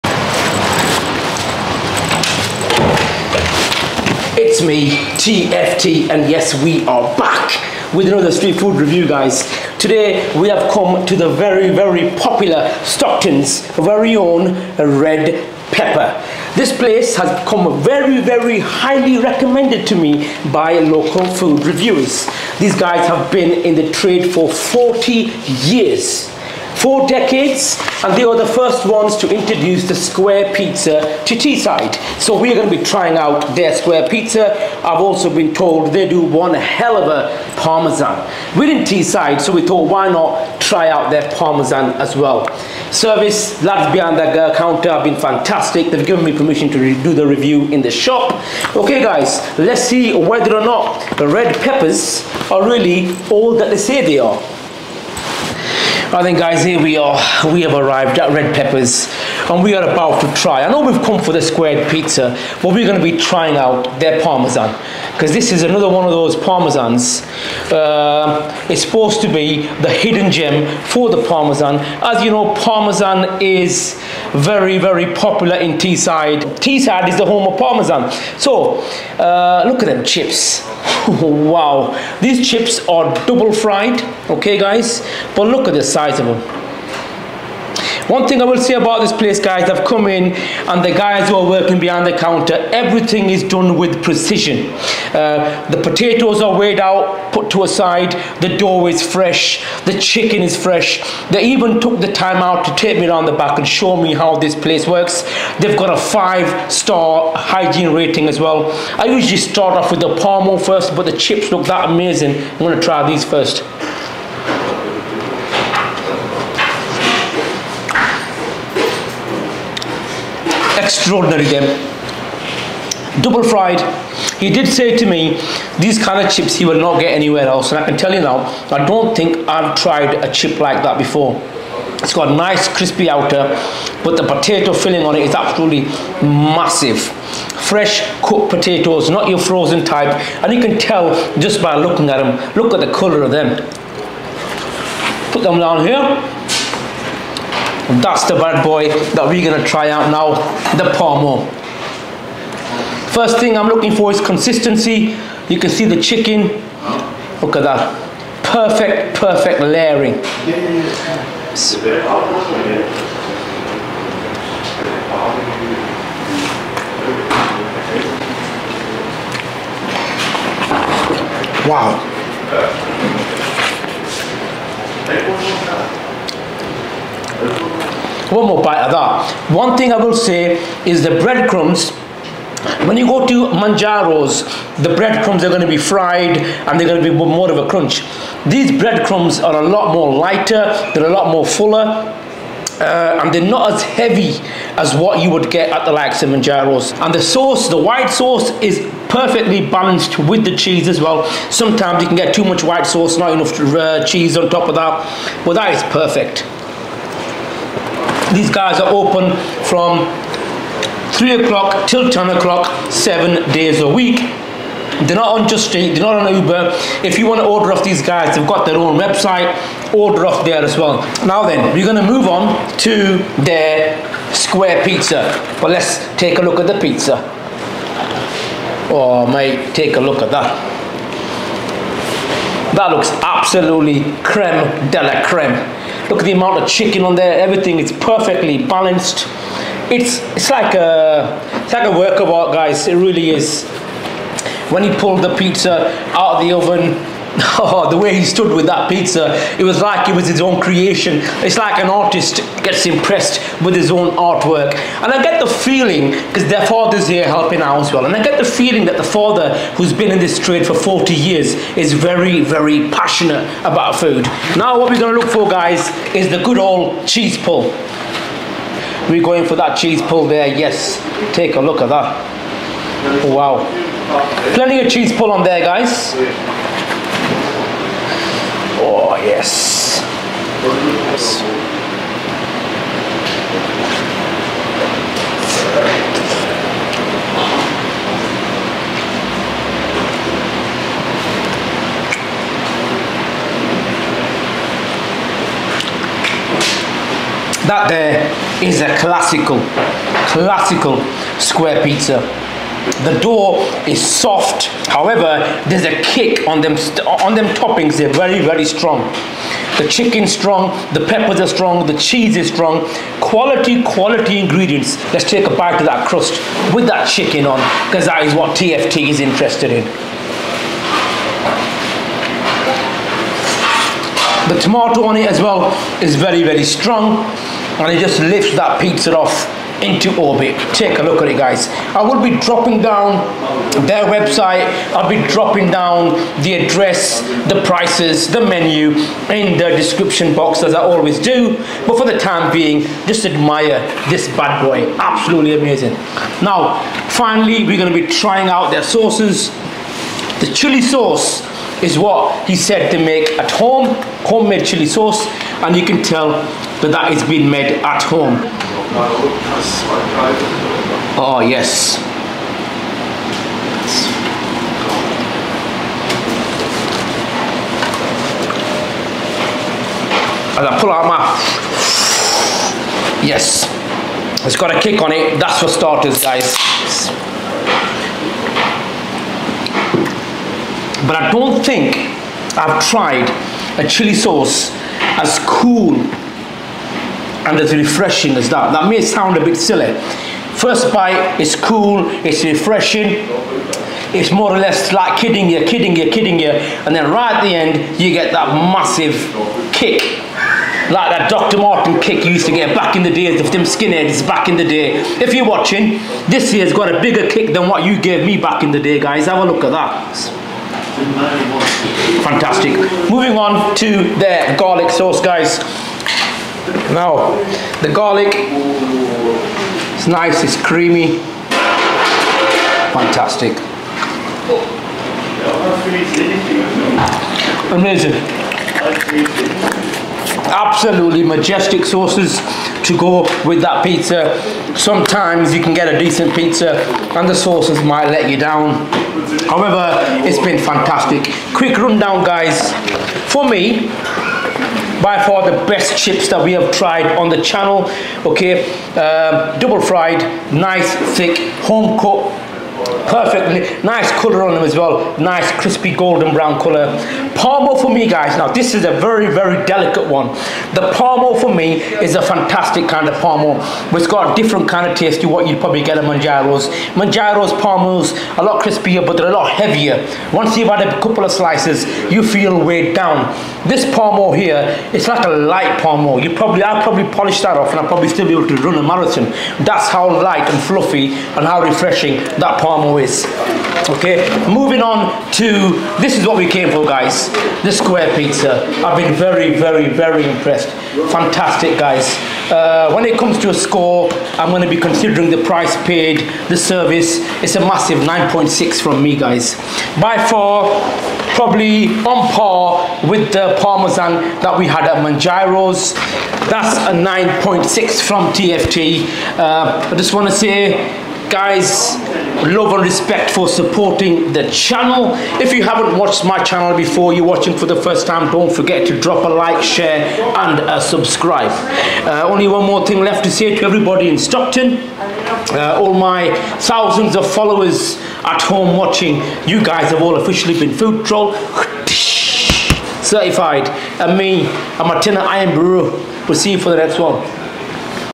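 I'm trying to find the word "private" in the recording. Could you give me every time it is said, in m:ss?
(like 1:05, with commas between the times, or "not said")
not said.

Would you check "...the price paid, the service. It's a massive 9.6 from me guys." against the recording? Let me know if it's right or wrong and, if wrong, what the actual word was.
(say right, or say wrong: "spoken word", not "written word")
right.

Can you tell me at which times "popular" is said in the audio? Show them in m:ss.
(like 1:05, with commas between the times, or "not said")
0:12, 1:15.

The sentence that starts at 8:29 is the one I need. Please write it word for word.
Uh, I just want to say, guys, love and respect for supporting the channel.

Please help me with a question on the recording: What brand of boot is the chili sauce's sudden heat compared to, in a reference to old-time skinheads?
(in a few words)
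Dr. Marten.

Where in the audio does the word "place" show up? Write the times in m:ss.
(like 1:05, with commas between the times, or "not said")
0:16, 1:29, 1:44.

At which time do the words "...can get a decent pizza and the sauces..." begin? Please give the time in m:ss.
7:15.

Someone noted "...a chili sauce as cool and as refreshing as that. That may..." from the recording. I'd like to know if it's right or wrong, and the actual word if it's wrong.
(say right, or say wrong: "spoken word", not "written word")
right.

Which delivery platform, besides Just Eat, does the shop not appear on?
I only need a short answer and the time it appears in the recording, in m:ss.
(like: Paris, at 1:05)
Uber, at 3:36.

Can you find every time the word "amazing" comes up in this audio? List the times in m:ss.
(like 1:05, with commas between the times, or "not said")
1:51, 5:45, 7:07.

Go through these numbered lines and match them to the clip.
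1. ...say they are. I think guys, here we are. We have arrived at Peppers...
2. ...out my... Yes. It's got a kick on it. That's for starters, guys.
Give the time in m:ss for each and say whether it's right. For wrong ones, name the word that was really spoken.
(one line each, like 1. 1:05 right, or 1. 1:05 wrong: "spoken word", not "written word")
1. 0:53 wrong: "Red", not "Peppers"
2. 6:10 right.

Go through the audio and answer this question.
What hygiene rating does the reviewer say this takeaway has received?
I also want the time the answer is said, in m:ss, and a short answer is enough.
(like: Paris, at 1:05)
five star, at 1:45.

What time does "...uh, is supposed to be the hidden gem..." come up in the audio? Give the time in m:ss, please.
1:07.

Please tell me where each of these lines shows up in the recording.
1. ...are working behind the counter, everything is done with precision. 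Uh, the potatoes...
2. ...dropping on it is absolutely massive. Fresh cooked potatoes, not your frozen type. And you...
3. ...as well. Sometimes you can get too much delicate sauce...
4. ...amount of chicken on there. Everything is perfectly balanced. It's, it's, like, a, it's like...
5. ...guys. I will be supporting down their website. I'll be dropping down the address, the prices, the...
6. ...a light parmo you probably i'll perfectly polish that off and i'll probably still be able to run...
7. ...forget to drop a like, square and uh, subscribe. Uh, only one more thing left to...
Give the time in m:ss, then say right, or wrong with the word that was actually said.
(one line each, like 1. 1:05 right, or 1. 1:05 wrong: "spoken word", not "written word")
1. 1:31 right
2. 2:14 wrong: "filling", not "dropping"
3. 3:20 wrong: "white", not "delicate"
4. 3:56 right
5. 5:31 wrong: "dropping", not "supporting"
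6. 7:55 wrong: "probably", not "perfectly"
7. 8:38 wrong: "share", not "square".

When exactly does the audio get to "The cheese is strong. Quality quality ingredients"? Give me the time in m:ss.
5:11.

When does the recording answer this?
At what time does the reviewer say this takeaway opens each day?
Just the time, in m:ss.
3:31.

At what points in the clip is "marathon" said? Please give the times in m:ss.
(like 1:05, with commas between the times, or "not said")
7:58.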